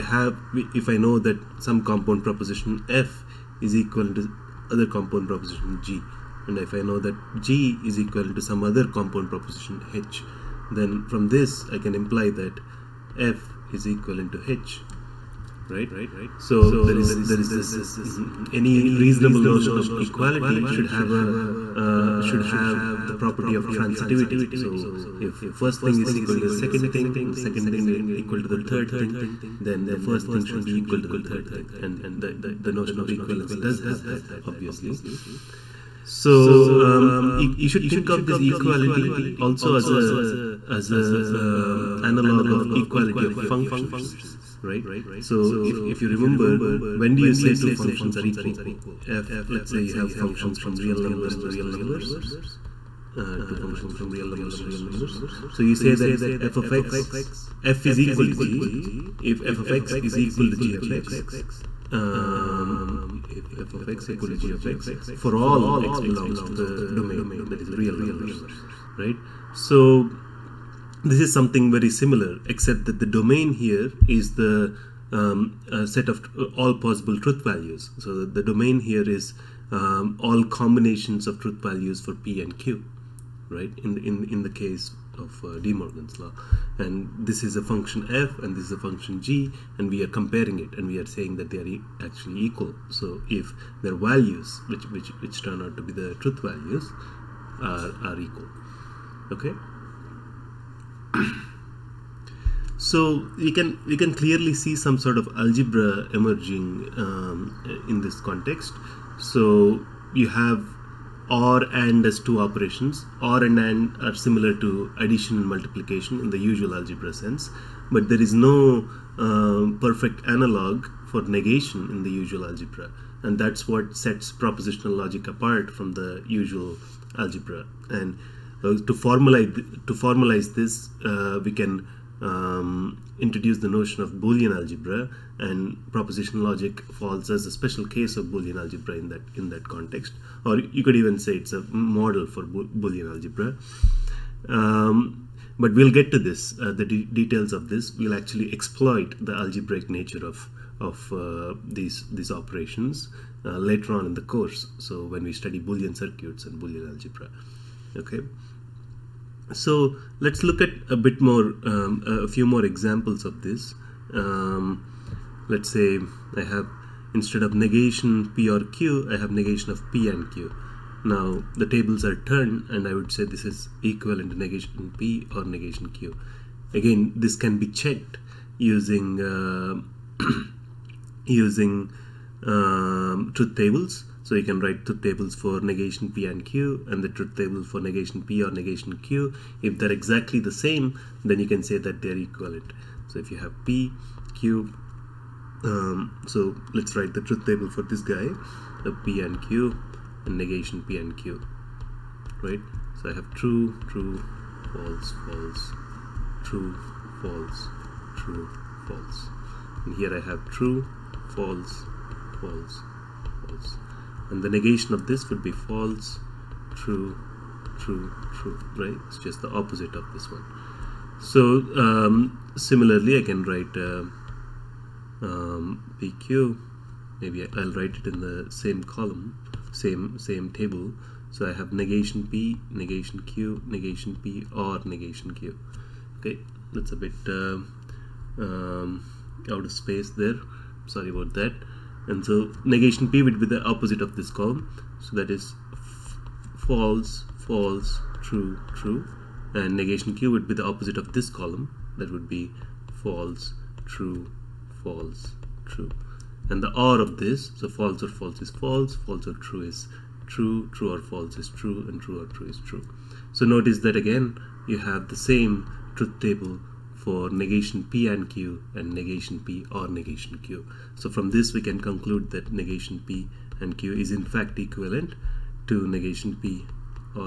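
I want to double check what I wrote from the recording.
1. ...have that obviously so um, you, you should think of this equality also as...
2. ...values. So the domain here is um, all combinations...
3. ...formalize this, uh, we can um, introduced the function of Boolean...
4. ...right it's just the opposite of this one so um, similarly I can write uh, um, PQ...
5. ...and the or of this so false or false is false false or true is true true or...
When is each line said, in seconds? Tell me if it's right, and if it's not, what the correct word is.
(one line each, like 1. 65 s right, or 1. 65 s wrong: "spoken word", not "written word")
1. 33 s right
2. 77 s right
3. 129 s wrong: "notion", not "function"
4. 218 s right
5. 256 s right.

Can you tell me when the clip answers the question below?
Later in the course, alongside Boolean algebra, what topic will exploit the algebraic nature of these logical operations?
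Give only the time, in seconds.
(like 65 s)
155 s.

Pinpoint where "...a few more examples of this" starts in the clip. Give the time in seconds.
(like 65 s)
162 s.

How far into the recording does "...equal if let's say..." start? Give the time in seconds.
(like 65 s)
48 s.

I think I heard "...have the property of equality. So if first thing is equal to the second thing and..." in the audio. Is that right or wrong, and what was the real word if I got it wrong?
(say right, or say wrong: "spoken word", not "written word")
wrong: "transitivity", not "equality".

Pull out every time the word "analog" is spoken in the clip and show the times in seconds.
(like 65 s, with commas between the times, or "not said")
42 s, 120 s.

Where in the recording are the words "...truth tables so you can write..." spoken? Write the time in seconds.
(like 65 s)
183 s.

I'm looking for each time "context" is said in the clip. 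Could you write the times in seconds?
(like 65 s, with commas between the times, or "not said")
108 s, 139 s.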